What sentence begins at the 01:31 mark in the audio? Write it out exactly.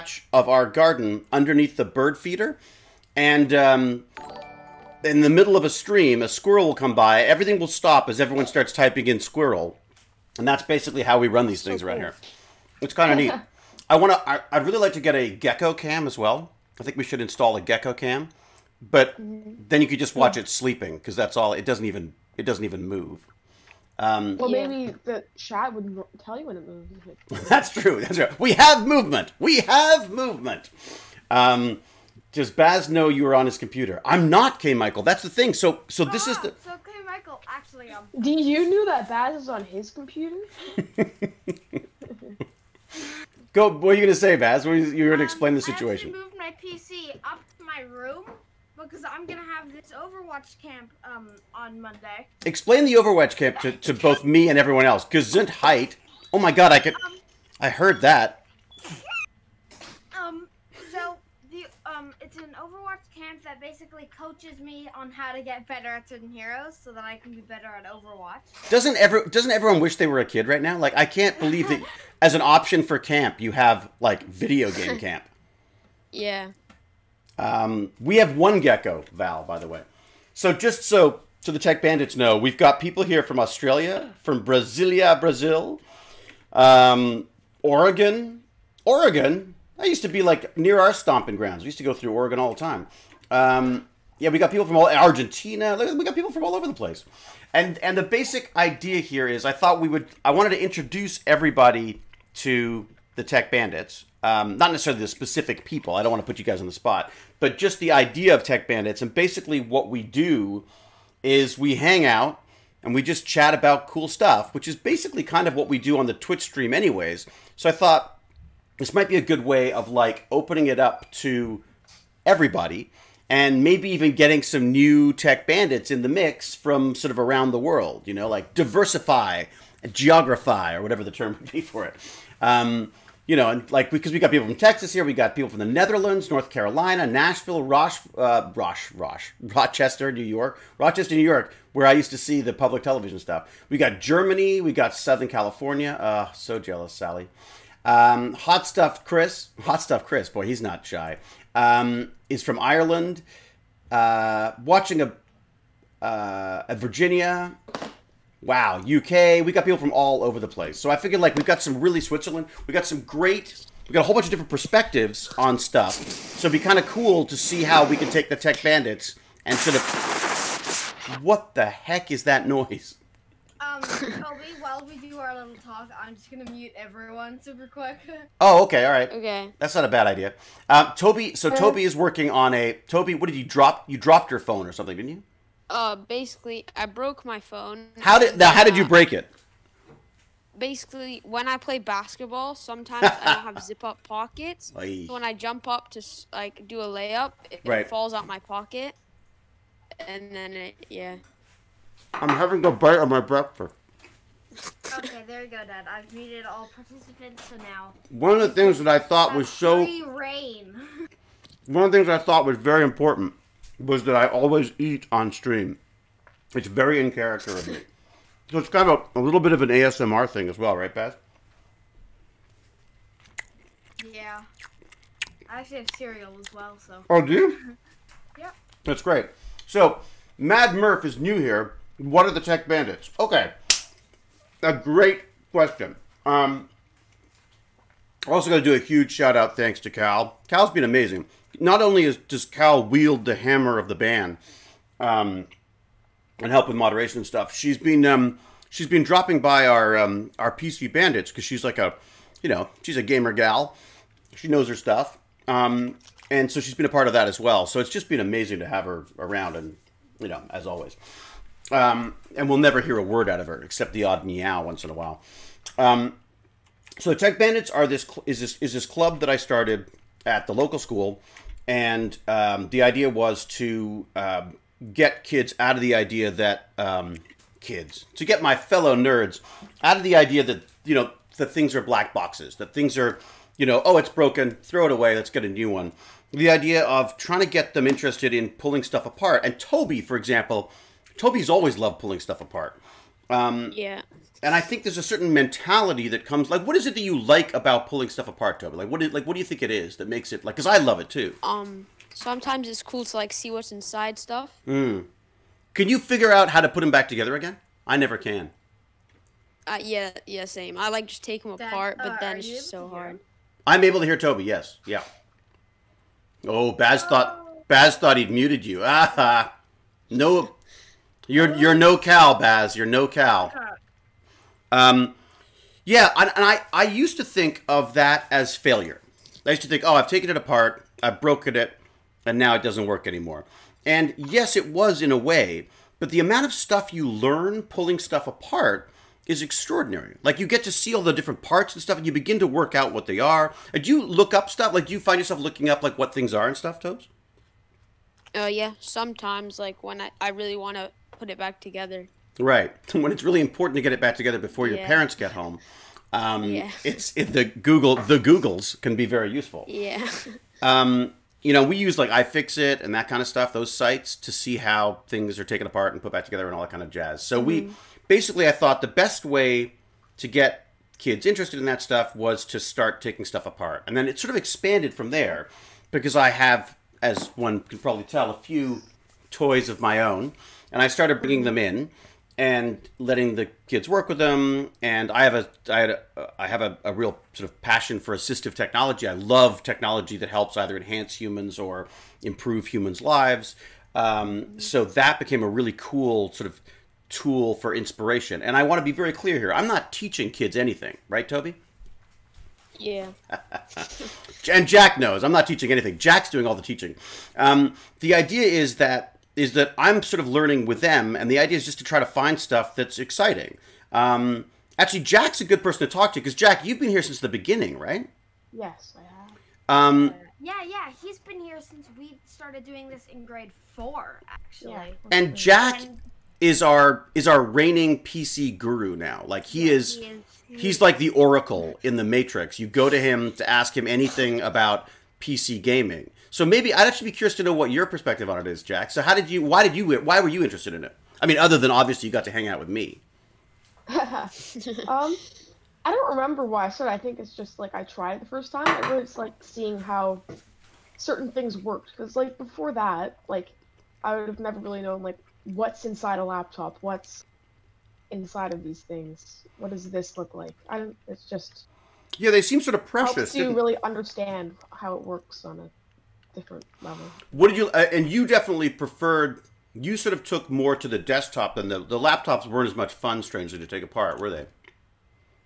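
We used to go through Oregon all the time.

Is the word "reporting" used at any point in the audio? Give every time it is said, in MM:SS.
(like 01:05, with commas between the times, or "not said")
not said.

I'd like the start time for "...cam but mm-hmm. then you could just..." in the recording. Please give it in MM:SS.
00:17.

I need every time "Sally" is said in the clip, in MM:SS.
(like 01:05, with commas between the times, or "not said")
02:26.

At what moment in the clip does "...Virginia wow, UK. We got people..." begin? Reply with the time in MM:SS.
02:36.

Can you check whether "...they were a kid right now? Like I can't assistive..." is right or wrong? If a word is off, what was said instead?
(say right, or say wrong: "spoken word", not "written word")
wrong: "believe", not "assistive".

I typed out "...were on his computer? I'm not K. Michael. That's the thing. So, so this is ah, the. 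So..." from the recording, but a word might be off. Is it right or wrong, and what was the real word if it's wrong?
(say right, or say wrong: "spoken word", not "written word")
right.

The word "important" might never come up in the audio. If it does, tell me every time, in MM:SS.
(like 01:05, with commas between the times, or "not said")
03:32, 05:53.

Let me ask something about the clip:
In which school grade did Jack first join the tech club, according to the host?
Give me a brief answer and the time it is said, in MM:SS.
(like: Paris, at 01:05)
grade 4, at 07:03.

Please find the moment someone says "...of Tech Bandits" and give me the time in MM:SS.
01:48.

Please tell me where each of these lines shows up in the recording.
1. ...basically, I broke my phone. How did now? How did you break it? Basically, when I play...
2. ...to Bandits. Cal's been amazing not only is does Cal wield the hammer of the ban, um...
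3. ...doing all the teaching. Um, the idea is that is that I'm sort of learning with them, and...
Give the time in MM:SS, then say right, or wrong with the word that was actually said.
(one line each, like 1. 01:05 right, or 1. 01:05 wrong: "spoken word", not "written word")
1. 03:05 right
2. 03:59 wrong: "Cal", not "Bandits"
3. 06:46 right.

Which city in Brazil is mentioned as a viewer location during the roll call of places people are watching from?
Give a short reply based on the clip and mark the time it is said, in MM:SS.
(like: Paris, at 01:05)
Brasilia, at 01:24.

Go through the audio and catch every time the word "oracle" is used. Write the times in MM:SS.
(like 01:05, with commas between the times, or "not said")
07:11.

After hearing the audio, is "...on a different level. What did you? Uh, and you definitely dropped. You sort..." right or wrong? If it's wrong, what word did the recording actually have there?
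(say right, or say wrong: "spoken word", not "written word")
wrong: "preferred", not "dropped".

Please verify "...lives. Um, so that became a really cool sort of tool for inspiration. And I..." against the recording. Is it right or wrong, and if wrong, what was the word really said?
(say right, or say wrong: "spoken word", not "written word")
right.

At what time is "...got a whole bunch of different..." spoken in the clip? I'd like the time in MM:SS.
02:43.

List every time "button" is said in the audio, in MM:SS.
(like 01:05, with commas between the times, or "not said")
not said.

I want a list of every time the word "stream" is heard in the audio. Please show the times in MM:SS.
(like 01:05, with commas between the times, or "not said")
00:05, 01:56, 03:35.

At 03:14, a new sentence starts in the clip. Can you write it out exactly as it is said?
So when I jump up to like do a layup, it, right.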